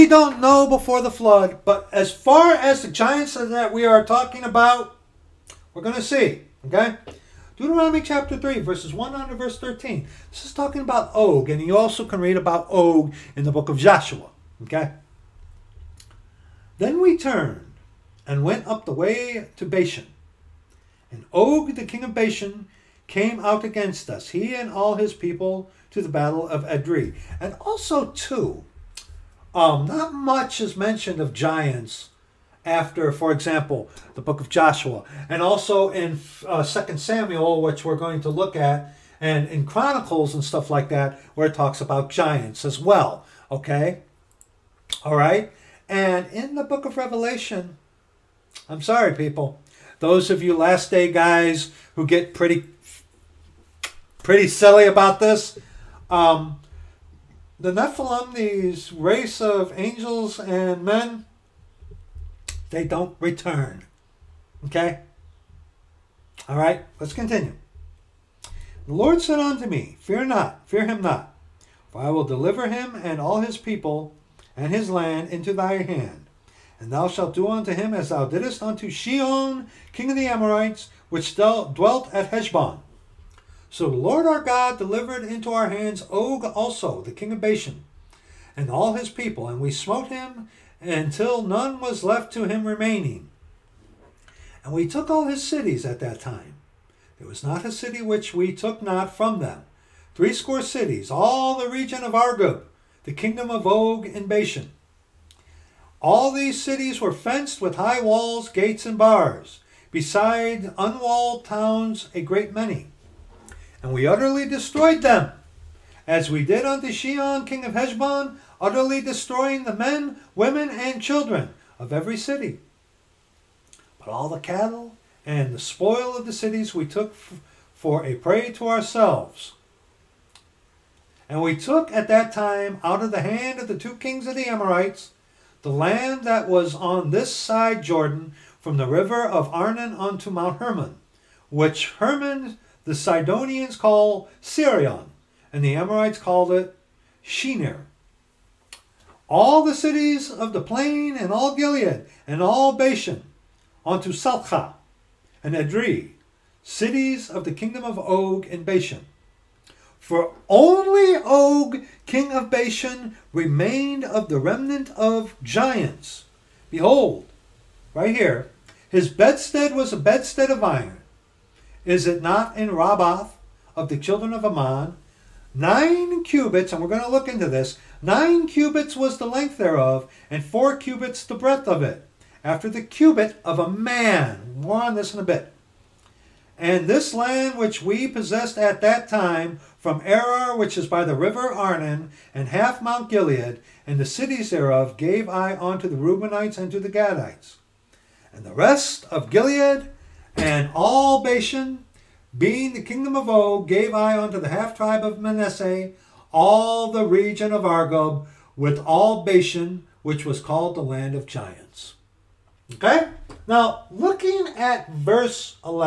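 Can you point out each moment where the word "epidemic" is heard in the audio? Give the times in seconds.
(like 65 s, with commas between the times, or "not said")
not said.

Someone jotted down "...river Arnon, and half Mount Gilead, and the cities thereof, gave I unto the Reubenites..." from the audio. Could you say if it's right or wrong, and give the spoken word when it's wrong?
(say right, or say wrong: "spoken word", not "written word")
right.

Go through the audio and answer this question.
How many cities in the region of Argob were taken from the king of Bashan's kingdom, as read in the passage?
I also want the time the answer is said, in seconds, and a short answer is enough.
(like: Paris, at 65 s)
60, at 100 s.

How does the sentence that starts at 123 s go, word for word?
But all the cattle and the spoil of the cities we took for a prey to ourselves.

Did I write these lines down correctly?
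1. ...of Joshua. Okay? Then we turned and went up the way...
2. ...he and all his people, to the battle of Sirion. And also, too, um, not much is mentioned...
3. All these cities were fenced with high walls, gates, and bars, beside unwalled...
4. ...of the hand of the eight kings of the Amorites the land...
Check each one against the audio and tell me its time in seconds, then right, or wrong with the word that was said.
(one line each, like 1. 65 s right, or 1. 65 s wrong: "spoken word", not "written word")
1. 13 s right
2. 24 s wrong: "Edrei", not "Sirion"
3. 106 s right
4. 133 s wrong: "two", not "eight".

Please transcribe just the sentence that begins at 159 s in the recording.
For only Og, king of Bashan, remained of the remnant of giants.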